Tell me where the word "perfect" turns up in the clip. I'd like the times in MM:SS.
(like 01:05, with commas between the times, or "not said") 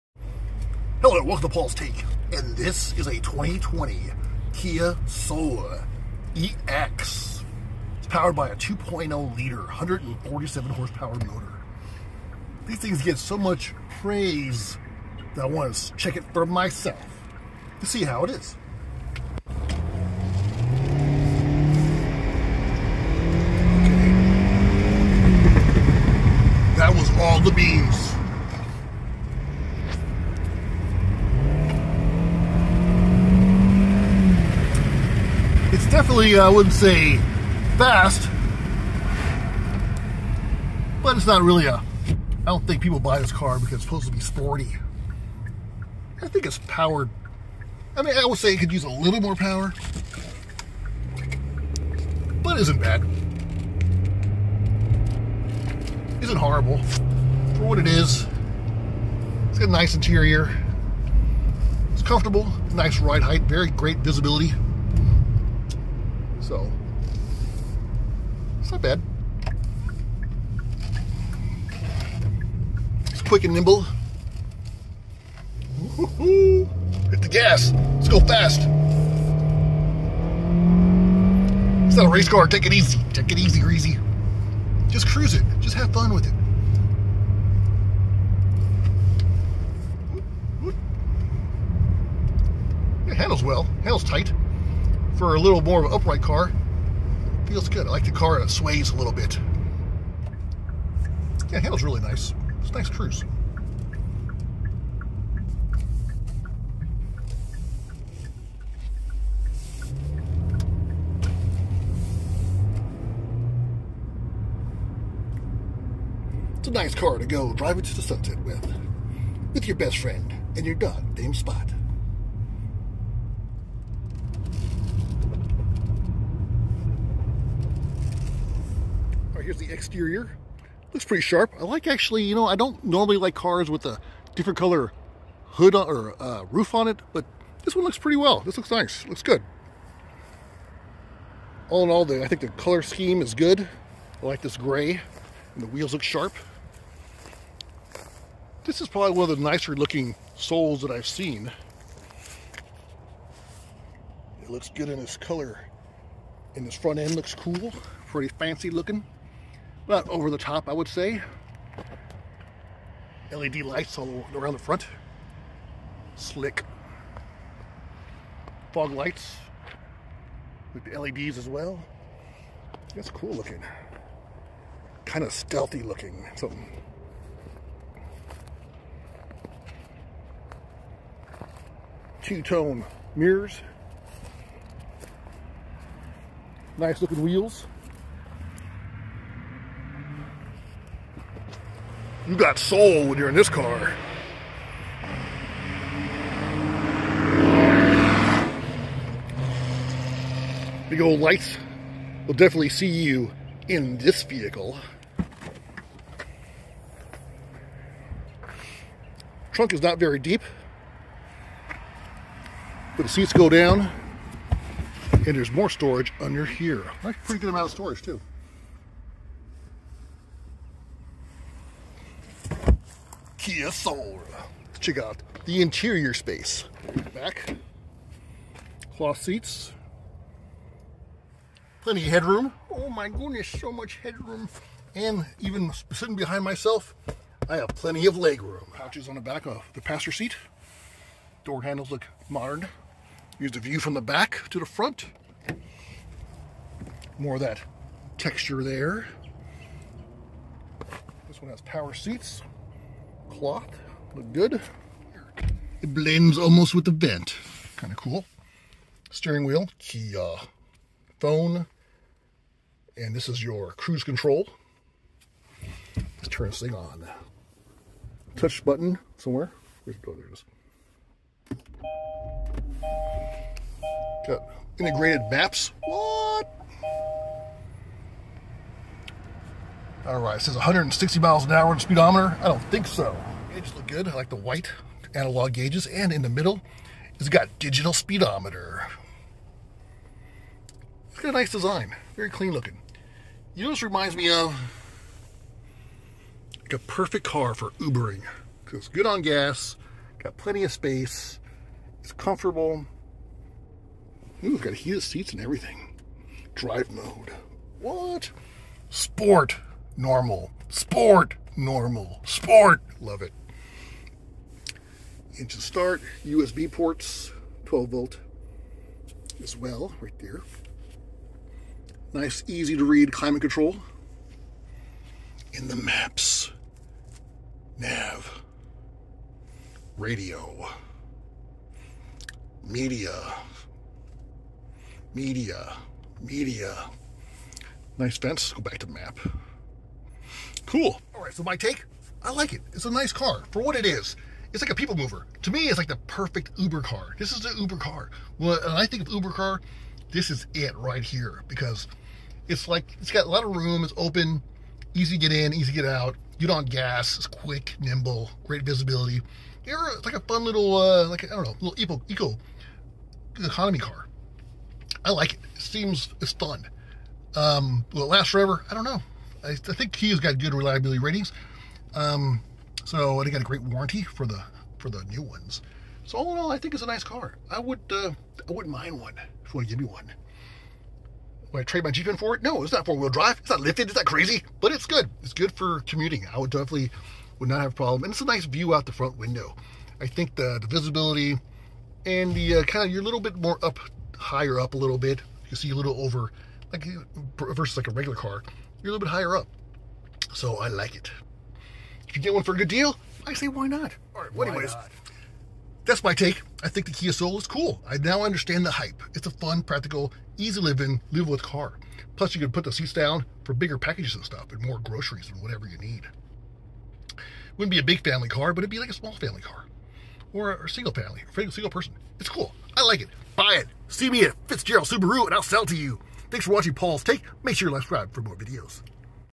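04:56, 05:46.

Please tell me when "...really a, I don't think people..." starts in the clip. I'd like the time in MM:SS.
00:41.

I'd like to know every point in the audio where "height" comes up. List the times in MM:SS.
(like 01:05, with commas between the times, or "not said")
01:03.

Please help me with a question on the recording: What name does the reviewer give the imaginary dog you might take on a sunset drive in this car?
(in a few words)
Spot.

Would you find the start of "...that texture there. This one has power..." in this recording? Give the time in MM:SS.
04:07.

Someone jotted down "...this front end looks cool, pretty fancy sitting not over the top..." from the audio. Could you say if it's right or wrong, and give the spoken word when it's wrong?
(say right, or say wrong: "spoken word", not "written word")
wrong: "looking", not "sitting".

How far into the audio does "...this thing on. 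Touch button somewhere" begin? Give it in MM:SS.
04:26.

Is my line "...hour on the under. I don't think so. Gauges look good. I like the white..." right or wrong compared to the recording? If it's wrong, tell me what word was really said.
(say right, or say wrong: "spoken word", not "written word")
wrong: "speedometer", not "under".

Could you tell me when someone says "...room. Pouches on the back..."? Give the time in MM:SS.
03:58.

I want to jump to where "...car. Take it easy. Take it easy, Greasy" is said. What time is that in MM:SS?
01:22.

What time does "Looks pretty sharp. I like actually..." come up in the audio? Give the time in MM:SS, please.
02:10.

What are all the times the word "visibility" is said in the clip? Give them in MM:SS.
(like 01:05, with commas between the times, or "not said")
01:03, 05:58, 06:30.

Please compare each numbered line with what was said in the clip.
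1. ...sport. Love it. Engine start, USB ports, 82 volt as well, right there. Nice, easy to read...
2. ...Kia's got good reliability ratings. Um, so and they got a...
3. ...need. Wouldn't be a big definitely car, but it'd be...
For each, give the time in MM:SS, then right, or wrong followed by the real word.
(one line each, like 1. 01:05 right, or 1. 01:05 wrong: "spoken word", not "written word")
1. 05:12 wrong: "12", not "82"
2. 06:09 right
3. 06:55 wrong: "family", not "definitely".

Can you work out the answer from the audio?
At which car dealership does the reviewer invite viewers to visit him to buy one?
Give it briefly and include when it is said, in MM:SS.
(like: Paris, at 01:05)
Fitzgerald Subaru, at 07:04.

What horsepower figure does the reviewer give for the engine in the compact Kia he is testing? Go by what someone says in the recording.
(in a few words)
147.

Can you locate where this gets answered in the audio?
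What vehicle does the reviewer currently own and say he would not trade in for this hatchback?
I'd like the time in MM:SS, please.
06:21.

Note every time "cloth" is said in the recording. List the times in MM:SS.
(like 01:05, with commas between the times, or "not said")
03:48, 04:13.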